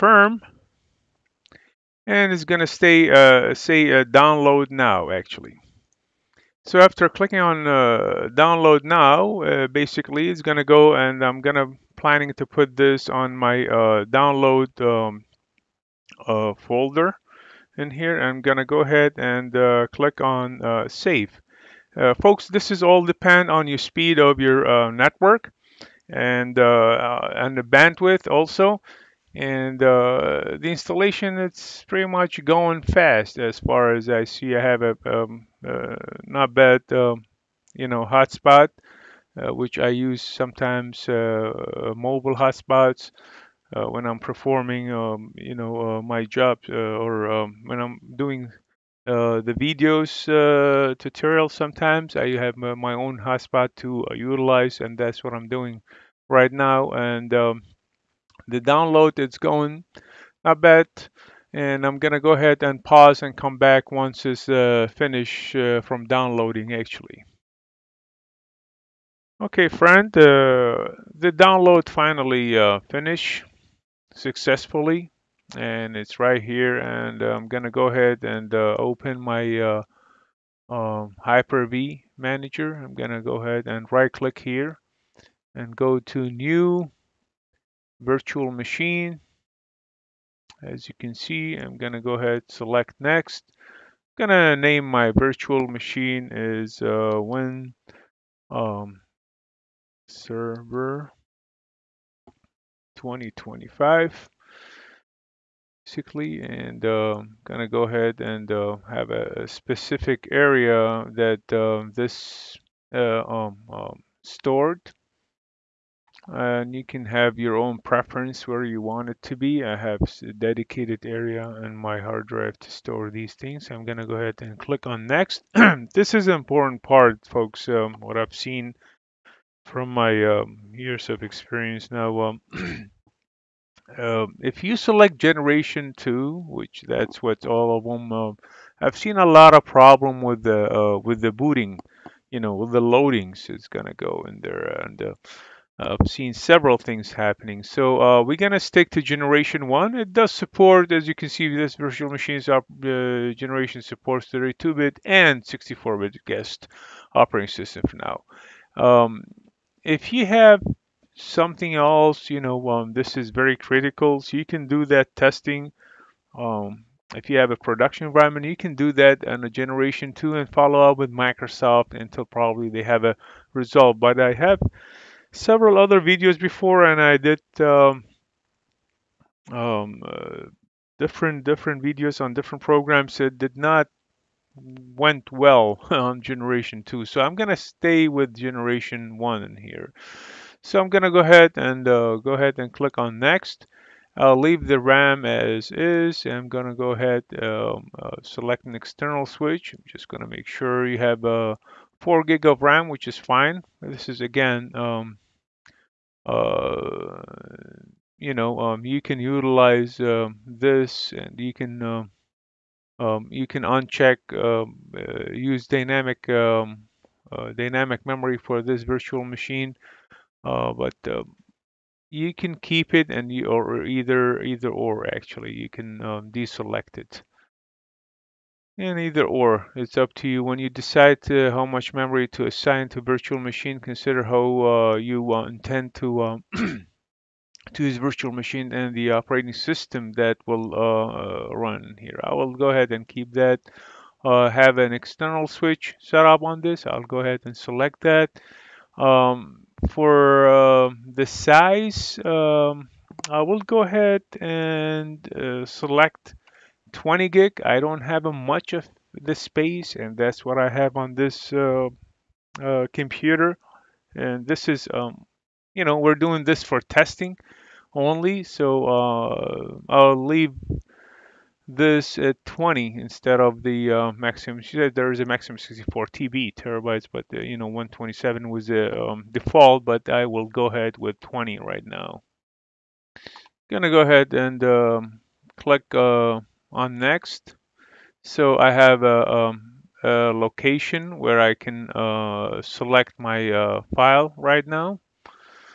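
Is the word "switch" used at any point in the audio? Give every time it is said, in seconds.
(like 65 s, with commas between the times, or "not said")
199 s, 245 s.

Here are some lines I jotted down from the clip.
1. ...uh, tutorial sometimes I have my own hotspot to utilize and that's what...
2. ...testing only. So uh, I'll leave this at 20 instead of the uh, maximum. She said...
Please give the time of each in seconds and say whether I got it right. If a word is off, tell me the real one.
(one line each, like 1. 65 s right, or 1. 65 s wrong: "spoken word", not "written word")
1. 50 s right
2. 266 s right.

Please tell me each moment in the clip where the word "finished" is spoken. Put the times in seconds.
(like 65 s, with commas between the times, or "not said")
64 s, 72 s.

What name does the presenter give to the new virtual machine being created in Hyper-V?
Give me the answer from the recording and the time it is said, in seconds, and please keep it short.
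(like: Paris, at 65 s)
Win server 2025, at 97 s.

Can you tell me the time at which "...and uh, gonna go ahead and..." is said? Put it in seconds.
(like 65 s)
106 s.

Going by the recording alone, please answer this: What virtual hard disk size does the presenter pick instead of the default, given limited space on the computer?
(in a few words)
20 GB.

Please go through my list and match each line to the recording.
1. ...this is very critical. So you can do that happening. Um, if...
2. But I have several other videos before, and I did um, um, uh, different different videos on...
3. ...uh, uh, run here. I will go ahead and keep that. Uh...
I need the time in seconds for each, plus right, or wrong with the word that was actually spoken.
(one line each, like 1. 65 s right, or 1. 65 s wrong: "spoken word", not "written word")
1. 162 s wrong: "testing", not "happening"
2. 173 s right
3. 240 s right.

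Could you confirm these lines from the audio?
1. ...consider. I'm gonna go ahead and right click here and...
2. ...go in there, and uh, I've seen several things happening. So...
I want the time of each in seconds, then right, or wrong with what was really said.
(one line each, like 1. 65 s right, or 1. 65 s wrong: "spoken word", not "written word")
1. 82 s wrong: "manager", not "consider"
2. 143 s right.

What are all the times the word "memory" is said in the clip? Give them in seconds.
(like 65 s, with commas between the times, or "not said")
218 s, 231 s.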